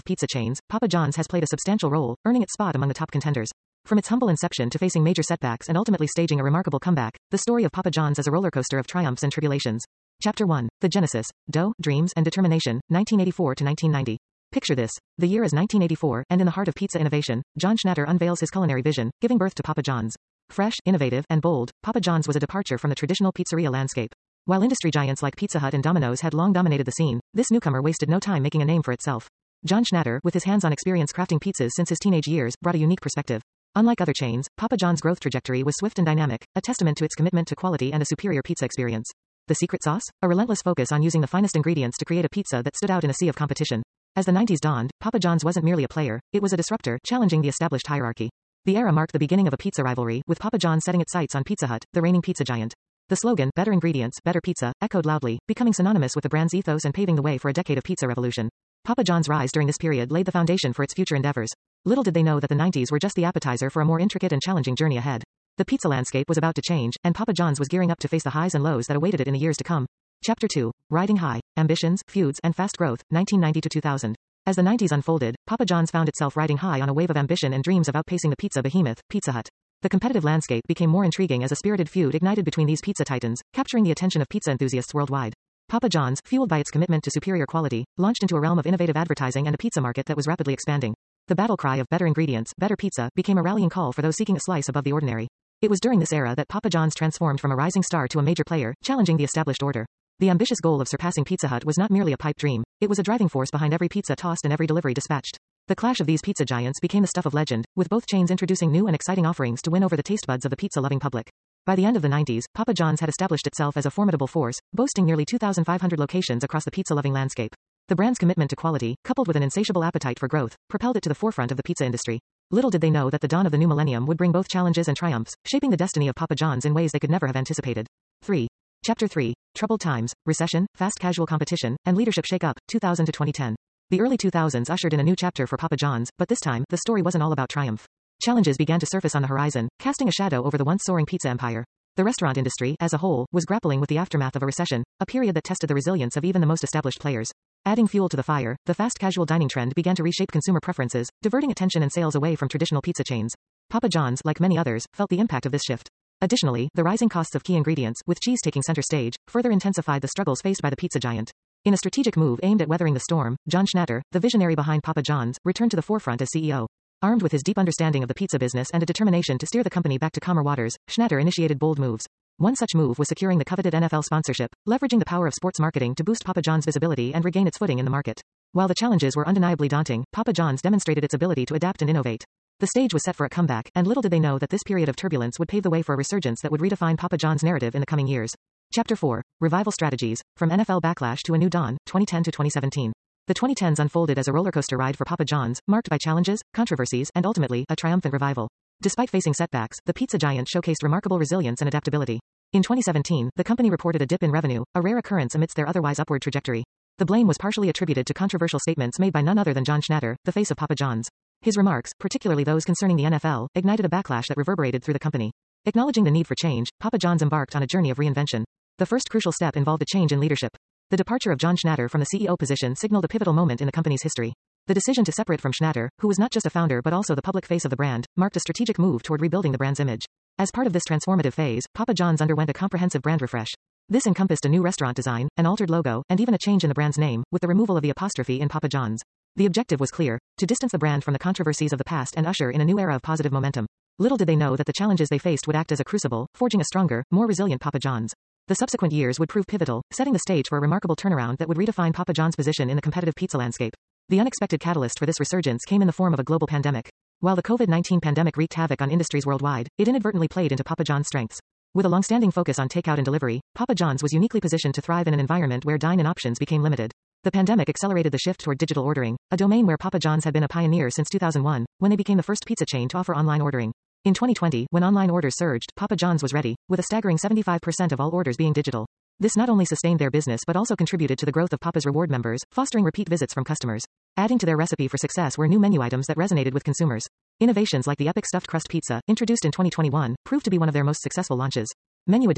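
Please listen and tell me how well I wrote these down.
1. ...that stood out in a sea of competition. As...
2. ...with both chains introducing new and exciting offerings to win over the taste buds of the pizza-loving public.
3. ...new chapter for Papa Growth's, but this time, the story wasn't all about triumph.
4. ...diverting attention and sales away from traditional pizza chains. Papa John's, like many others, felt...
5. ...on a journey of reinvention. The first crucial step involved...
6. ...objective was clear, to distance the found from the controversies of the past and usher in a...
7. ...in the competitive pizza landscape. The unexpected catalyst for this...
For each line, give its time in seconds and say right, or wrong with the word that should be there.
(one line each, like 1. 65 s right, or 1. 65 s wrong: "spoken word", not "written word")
1. 42 s right
2. 107 s right
3. 135 s wrong: "John", not "Growth"
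4. 151 s right
5. 217 s right
6. 239 s wrong: "brand", not "found"
7. 252 s right.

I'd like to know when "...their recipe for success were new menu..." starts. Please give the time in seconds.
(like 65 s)
284 s.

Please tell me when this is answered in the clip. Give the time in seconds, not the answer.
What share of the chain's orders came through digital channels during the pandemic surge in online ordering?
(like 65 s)
277 s.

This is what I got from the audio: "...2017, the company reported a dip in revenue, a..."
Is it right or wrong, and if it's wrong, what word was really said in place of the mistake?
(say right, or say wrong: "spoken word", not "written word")
right.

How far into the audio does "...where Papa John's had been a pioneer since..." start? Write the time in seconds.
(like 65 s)
269 s.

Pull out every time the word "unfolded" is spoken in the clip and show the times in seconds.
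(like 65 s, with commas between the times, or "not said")
74 s, 193 s.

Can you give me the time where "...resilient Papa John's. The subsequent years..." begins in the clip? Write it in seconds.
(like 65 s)
247 s.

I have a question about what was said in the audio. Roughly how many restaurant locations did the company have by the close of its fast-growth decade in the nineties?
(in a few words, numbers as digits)
2,500.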